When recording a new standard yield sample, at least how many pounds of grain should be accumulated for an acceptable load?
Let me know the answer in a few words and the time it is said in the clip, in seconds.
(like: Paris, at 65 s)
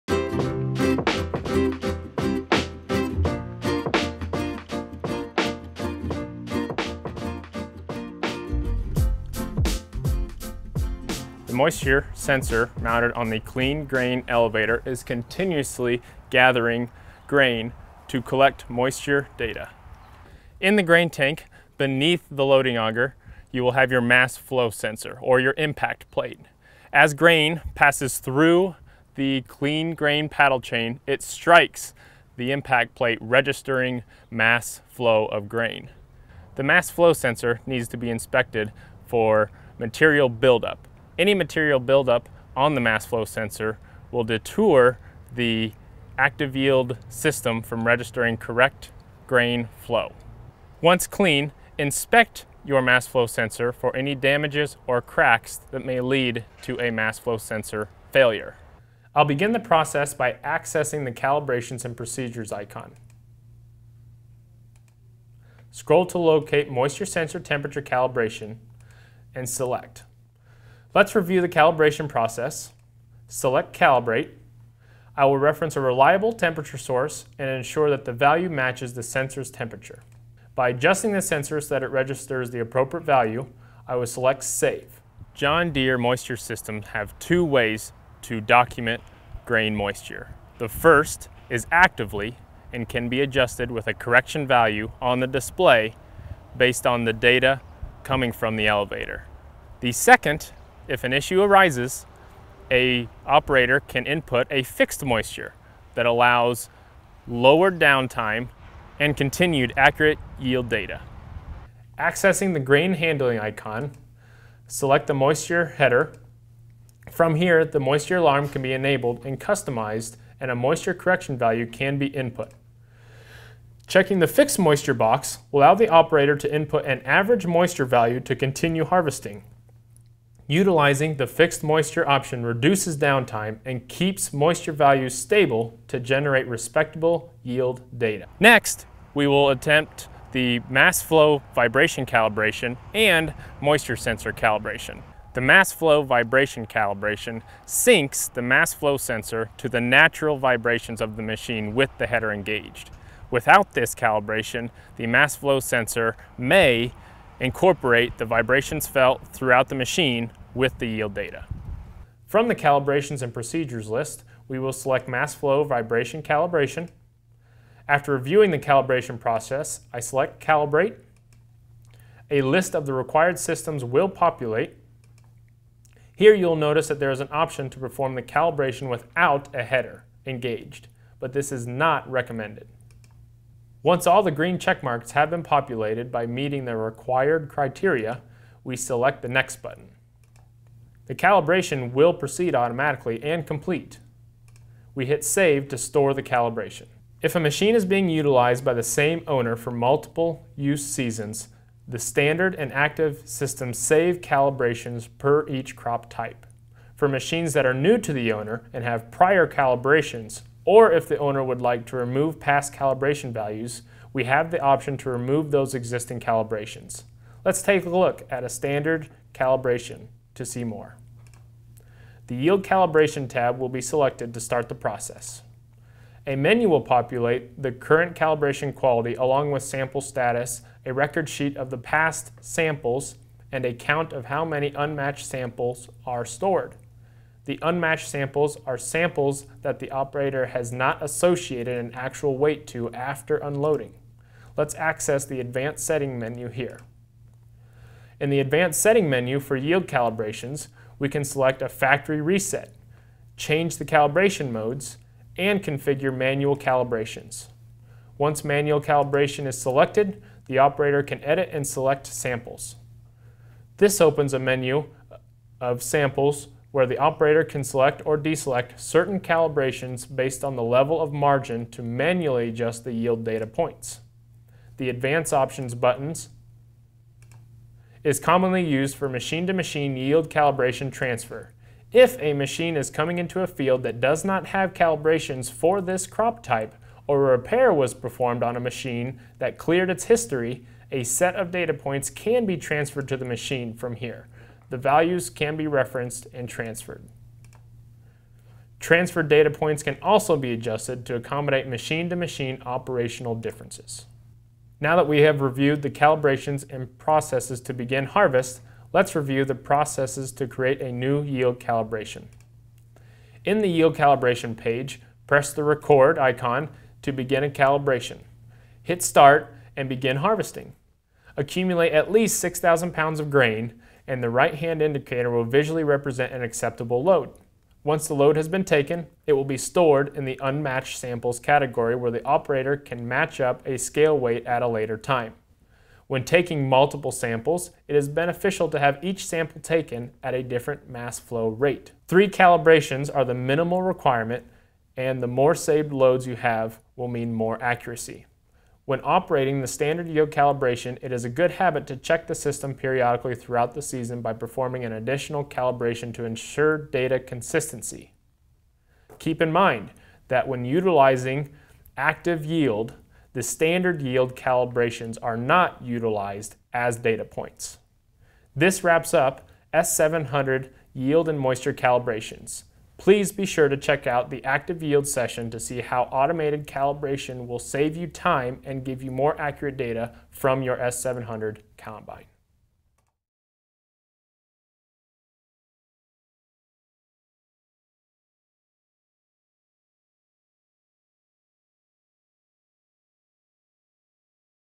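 6,000 pounds, at 322 s.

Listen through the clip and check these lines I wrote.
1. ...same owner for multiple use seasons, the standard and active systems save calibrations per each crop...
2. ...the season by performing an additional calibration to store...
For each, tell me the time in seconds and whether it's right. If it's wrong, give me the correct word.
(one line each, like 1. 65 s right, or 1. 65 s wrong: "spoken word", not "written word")
1. 198 s right
2. 353 s wrong: "ensure", not "store".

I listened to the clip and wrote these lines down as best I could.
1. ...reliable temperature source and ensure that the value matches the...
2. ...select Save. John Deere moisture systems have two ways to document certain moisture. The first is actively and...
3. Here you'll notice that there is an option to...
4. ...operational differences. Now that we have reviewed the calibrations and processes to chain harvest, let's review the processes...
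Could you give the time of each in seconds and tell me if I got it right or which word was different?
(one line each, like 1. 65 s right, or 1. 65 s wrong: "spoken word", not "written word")
1. 75 s right
2. 84 s wrong: "grain", not "certain"
3. 176 s right
4. 302 s wrong: "begin", not "chain".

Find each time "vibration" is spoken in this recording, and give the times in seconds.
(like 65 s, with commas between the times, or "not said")
141 s, 146 s, 150 s, 158 s, 165 s.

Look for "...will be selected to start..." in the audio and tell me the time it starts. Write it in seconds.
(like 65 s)
223 s.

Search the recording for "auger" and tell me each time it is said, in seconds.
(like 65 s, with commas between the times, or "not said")
22 s.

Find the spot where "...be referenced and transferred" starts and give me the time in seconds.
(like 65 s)
295 s.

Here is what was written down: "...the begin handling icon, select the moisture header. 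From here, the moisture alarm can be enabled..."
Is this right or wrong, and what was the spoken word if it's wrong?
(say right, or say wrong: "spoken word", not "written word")
wrong: "grain", not "begin".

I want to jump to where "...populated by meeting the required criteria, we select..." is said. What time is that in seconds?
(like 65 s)
185 s.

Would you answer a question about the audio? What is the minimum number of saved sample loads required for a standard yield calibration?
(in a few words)
3.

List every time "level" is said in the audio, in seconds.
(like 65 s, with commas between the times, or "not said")
270 s.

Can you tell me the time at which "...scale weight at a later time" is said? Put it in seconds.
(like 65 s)
333 s.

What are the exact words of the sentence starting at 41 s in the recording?
Any material buildup on the mass flow sensor will detour the active yield system from registering correct grain flow.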